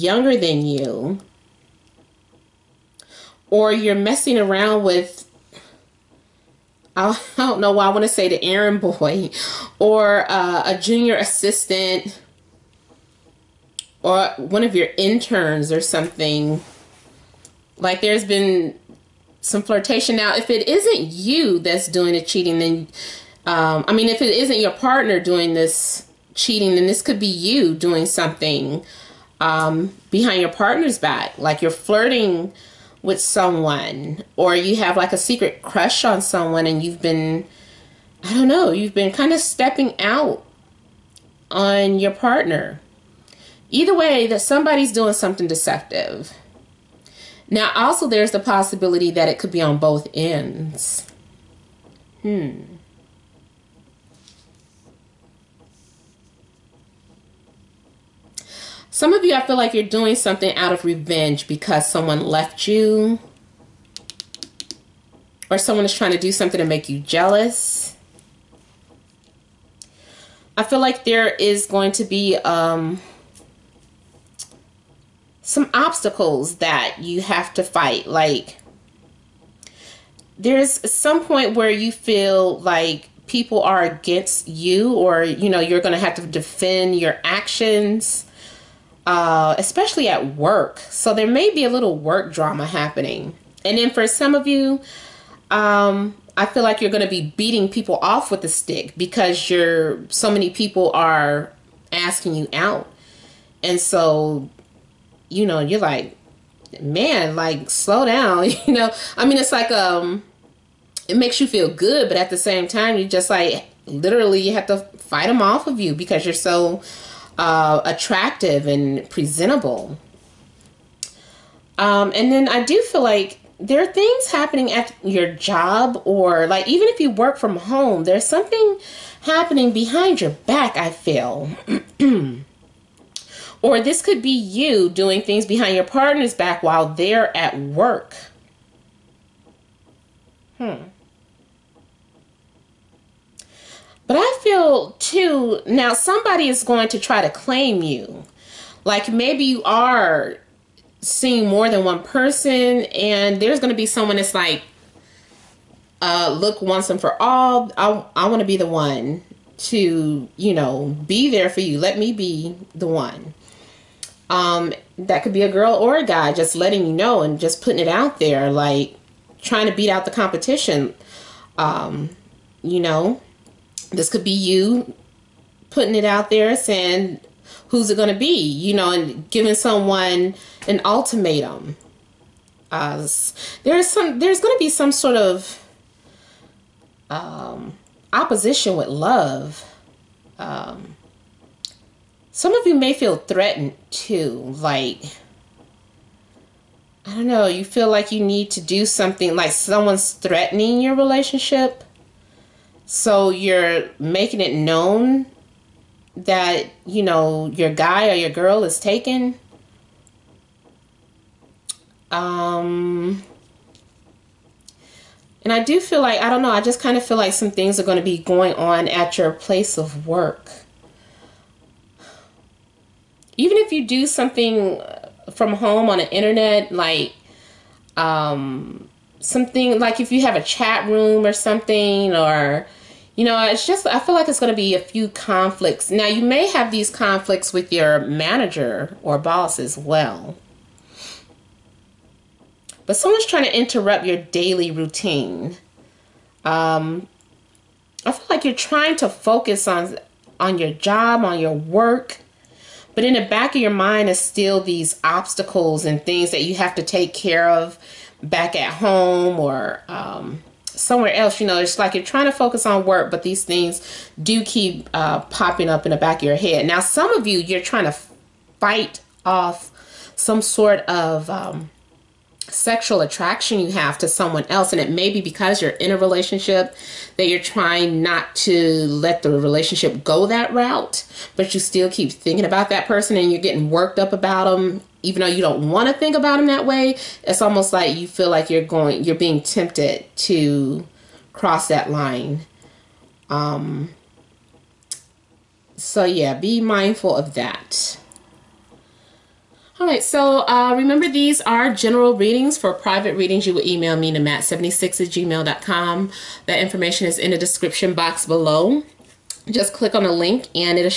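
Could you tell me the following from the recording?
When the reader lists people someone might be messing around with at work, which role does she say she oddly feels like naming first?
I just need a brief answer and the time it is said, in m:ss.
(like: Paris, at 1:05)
errand boy, at 0:08.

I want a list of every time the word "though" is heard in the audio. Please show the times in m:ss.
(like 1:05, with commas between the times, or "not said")
4:45.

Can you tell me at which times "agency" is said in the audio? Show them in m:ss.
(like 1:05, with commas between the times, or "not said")
not said.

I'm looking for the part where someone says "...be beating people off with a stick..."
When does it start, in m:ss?
1:37.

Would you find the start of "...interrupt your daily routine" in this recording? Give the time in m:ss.
4:03.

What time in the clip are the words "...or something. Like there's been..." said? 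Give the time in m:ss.
0:15.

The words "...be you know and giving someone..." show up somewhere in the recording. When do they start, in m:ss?
2:58.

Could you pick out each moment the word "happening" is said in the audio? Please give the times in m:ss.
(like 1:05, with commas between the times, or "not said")
1:32, 2:04, 2:09.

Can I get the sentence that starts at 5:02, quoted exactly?
For private readings, you will email me to matt76 at gmail.com.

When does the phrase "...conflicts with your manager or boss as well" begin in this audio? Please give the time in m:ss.
3:56.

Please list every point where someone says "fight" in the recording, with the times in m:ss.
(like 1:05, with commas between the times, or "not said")
1:17, 1:54, 4:28.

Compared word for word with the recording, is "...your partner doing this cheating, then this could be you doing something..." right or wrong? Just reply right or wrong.
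right.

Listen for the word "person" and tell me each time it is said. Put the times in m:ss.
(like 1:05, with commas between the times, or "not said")
2:32, 4:42.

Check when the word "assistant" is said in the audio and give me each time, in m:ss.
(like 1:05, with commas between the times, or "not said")
0:11.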